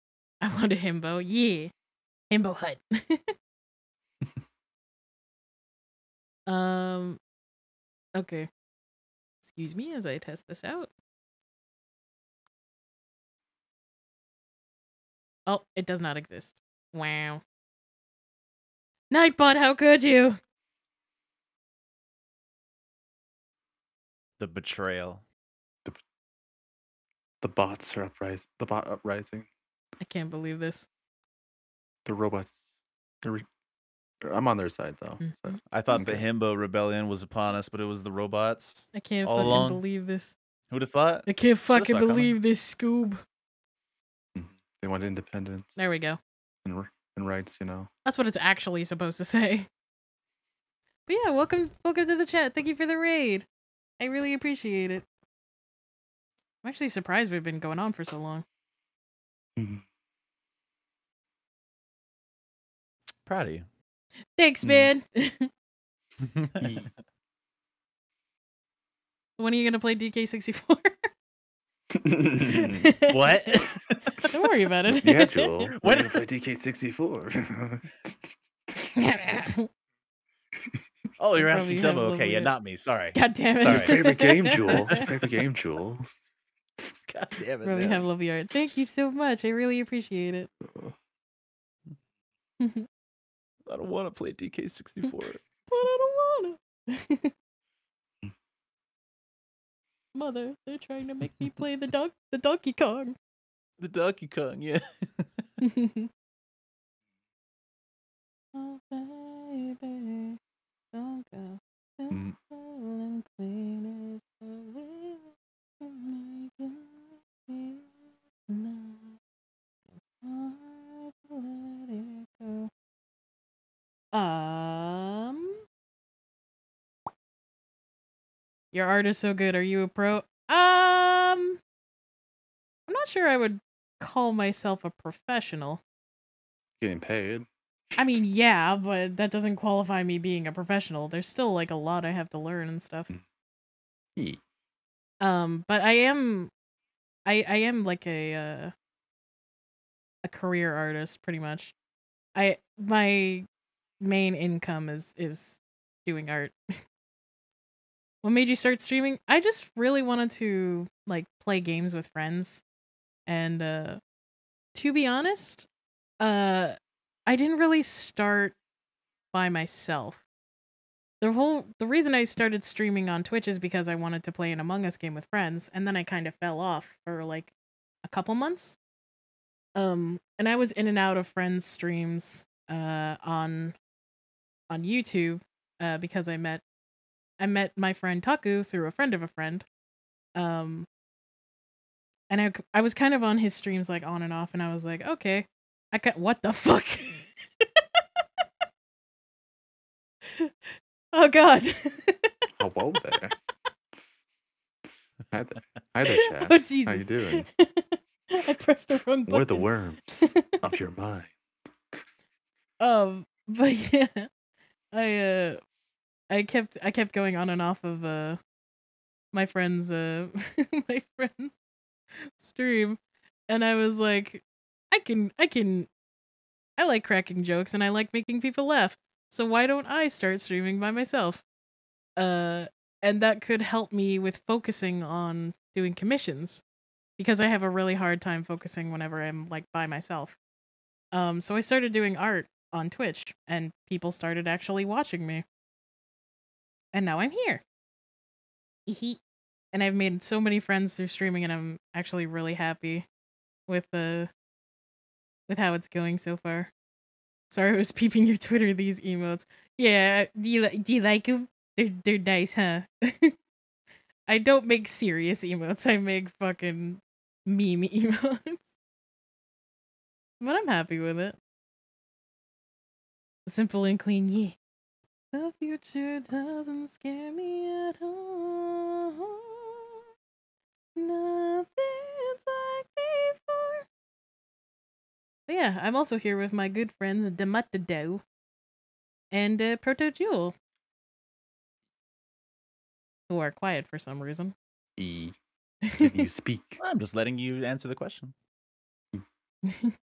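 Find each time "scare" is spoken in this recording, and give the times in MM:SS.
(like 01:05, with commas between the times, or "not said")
04:36.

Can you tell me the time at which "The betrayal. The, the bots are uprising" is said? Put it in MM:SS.
00:24.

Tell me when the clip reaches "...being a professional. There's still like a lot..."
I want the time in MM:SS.
02:20.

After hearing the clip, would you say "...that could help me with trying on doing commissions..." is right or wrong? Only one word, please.
wrong.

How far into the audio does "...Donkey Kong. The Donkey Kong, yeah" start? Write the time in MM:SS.
01:42.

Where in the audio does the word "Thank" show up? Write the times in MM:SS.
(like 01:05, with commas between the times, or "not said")
00:52, 01:04, 01:28.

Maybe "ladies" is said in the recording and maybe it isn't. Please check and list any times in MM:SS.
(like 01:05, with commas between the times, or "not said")
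not said.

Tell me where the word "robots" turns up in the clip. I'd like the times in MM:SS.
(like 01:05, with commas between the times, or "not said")
00:32, 00:38.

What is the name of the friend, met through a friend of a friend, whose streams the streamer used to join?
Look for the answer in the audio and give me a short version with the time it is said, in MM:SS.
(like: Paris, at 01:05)
Taku, at 03:08.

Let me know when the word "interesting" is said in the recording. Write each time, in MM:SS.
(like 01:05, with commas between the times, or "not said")
not said.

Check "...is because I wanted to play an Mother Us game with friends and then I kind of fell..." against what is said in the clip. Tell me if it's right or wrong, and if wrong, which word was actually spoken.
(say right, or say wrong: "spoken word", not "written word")
wrong: "Among", not "Mother".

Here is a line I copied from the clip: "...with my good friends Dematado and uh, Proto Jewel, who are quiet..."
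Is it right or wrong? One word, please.
right.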